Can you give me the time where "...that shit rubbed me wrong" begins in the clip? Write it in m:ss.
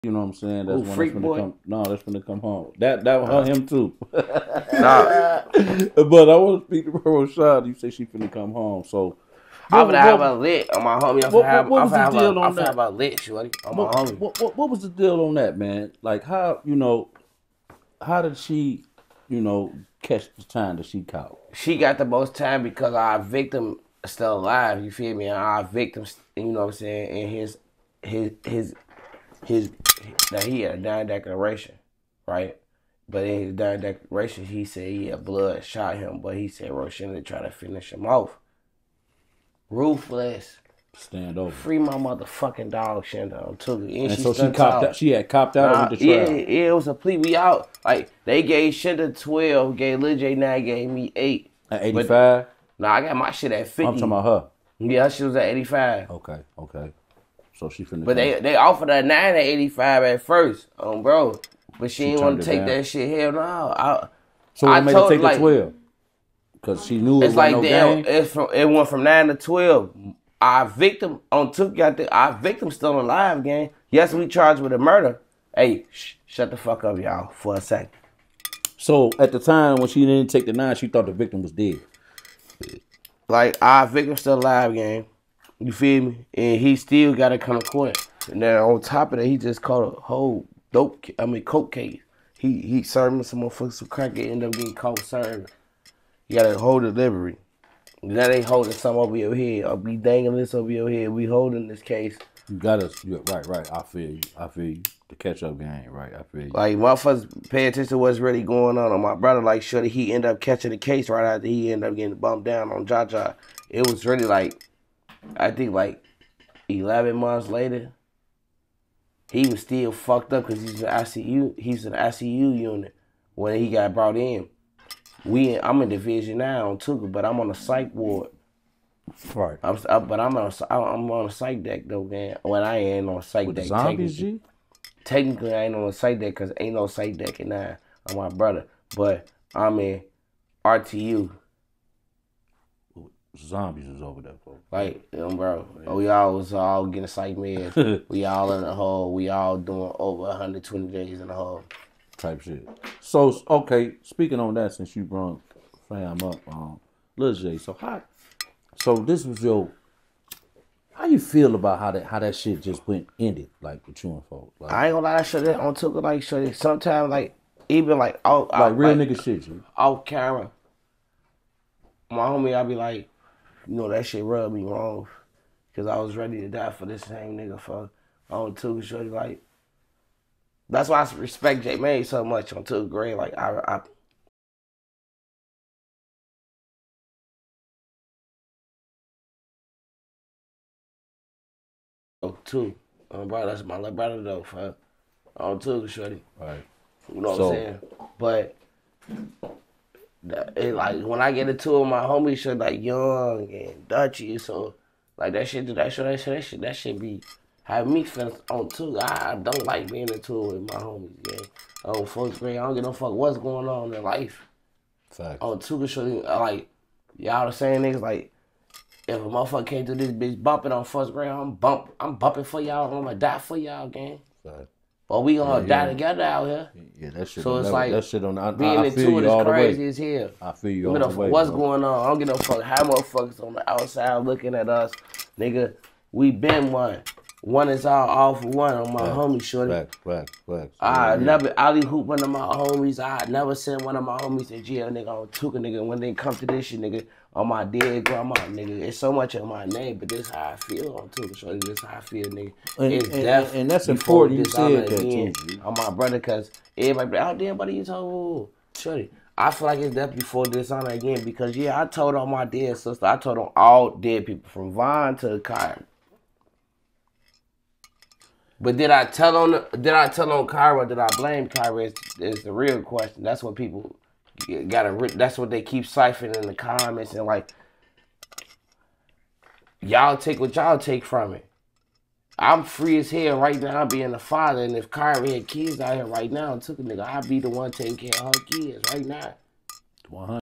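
2:53.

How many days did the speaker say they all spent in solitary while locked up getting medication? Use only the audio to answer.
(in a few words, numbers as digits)
Over 120.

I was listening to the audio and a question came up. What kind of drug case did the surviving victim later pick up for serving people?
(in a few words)
Coke case.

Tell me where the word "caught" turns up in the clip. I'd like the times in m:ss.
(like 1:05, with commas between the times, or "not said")
0:21, 1:29, 1:34.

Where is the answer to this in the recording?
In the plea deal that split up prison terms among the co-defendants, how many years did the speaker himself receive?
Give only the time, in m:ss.
0:51.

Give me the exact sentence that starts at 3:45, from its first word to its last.
But we gonna yeah, die yeah.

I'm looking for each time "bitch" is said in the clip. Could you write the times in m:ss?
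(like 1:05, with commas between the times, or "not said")
3:40.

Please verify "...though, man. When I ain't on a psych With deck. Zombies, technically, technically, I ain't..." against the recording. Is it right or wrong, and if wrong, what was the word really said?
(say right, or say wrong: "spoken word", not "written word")
right.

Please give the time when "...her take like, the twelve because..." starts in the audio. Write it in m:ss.
1:04.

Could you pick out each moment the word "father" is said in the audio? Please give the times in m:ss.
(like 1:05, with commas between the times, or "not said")
4:44.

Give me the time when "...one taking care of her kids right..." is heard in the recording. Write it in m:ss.
4:47.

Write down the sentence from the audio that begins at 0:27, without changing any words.
And his, his, his, his now he had a dying declaration, right?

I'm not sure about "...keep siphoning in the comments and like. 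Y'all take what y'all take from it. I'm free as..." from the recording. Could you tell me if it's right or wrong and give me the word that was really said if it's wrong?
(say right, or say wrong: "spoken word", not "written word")
right.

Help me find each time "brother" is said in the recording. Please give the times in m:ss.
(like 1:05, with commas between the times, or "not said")
1:49, 2:18, 3:13, 4:15.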